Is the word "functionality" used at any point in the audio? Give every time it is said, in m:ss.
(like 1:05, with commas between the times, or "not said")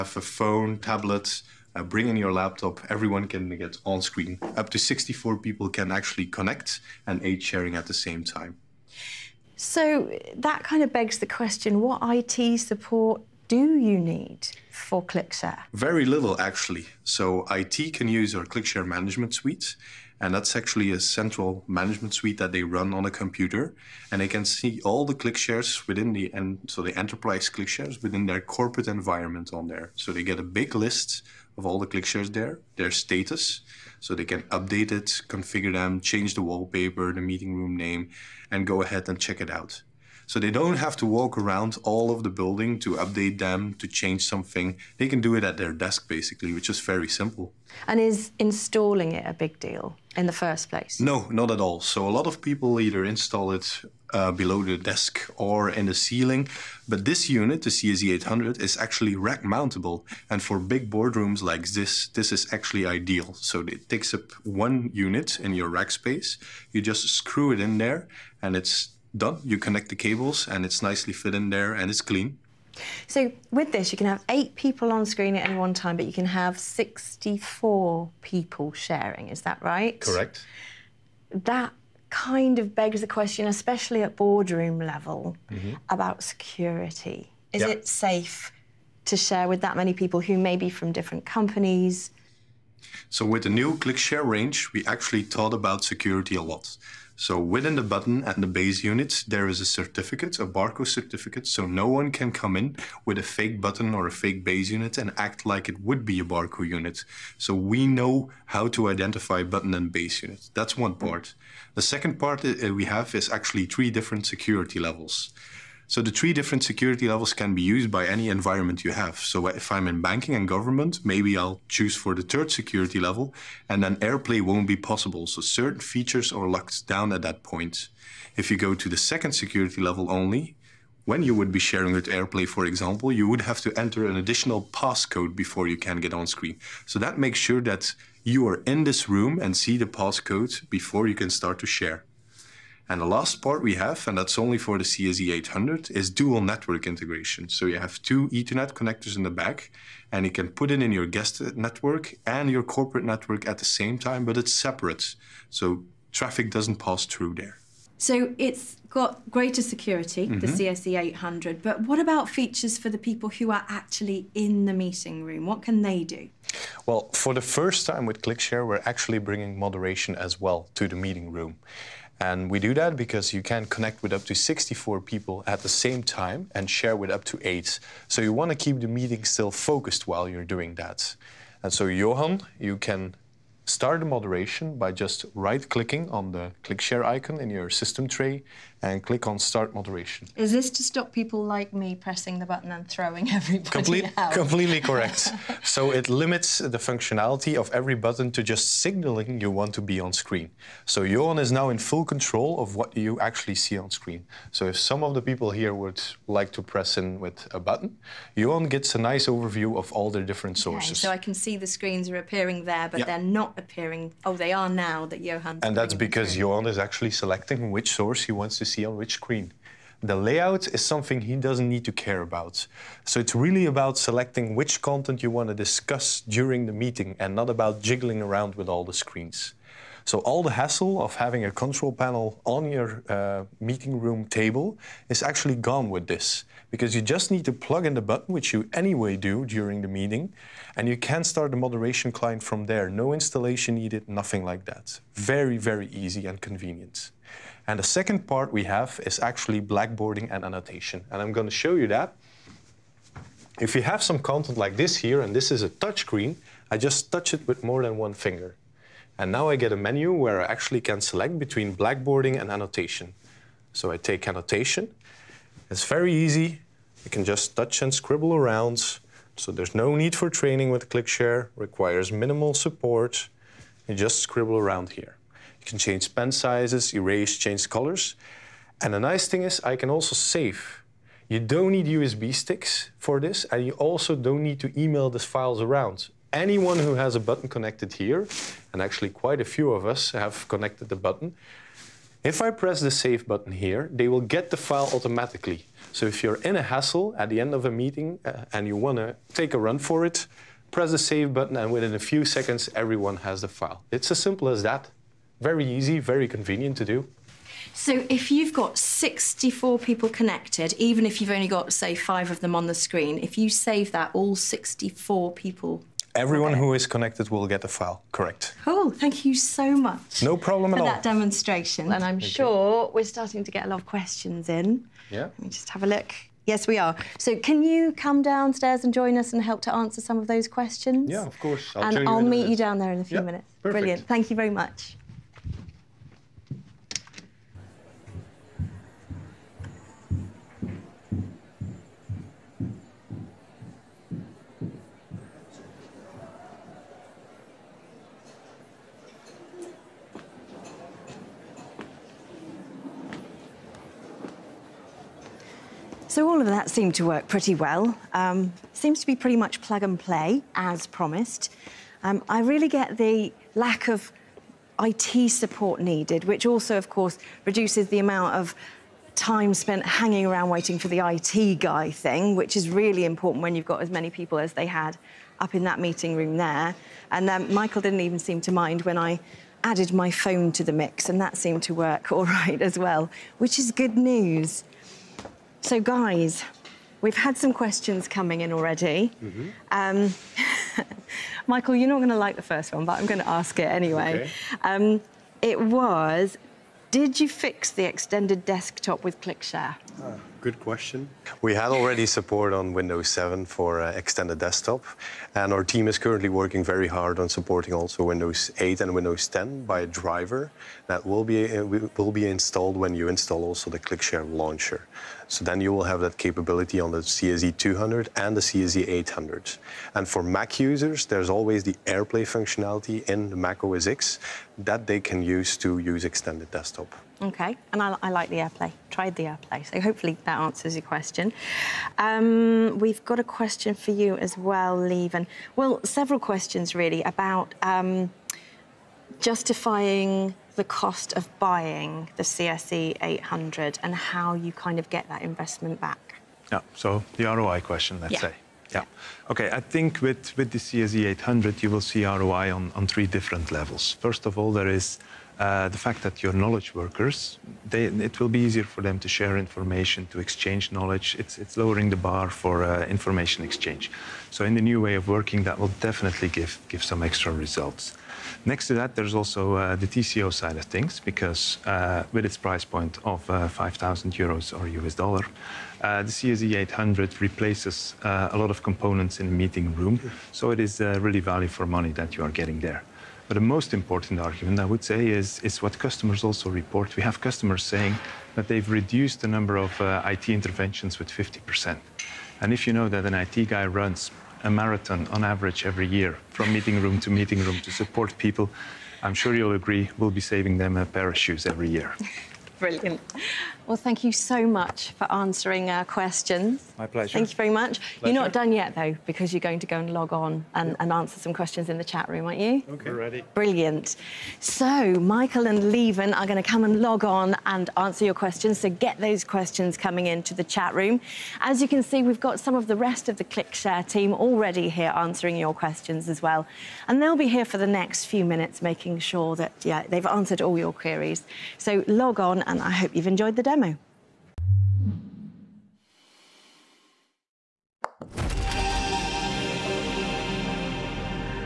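3:16, 7:02.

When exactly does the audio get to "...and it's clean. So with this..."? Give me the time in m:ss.
1:11.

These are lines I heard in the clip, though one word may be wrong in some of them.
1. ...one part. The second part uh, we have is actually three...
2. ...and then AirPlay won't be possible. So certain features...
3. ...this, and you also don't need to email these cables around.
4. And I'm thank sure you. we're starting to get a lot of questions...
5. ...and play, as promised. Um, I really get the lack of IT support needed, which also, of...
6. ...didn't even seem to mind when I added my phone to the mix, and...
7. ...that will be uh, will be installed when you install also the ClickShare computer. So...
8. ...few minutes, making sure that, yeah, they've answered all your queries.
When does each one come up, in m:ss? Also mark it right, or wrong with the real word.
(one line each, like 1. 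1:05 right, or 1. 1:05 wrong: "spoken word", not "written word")
1. 1:50 right
2. 2:03 right
3. 4:43 wrong: "files", not "cables"
4. 5:21 right
5. 5:59 right
6. 6:17 right
7. 6:50 wrong: "launcher", not "computer"
8. 8:48 right.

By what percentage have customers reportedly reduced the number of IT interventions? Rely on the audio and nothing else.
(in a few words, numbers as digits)
50%.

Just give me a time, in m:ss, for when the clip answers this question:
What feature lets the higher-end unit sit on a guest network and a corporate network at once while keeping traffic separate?
2:26.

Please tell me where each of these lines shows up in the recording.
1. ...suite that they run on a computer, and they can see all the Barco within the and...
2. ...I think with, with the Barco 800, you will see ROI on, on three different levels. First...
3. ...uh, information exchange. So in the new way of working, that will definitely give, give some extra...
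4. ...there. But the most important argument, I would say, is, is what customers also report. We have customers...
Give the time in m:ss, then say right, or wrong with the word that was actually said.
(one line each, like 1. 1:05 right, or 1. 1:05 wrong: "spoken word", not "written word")
1. 0:22 wrong: "ClickShares", not "Barco"
2. 7:29 wrong: "CSE", not "Barco"
3. 7:42 right
4. 8:02 right.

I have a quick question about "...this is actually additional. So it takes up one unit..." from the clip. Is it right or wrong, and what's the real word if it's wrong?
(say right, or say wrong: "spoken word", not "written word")
wrong: "ideal", not "additional".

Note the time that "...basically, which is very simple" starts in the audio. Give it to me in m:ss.
0:46.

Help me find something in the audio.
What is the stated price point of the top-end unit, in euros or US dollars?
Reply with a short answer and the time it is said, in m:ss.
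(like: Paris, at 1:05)
5,000, at 7:53.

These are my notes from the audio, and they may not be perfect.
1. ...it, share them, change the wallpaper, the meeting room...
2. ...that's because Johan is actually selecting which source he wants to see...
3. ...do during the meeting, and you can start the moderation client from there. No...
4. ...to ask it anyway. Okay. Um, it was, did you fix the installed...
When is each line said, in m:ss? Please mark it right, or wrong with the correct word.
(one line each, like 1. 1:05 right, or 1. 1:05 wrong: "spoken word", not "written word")
1. 0:34 wrong: "configure", not "share"
2. 3:35 right
3. 3:59 right
4. 6:33 wrong: "extended", not "installed".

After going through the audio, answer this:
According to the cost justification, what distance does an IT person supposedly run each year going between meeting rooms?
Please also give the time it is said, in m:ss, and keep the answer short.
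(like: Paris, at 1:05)
A marathon, at 8:14.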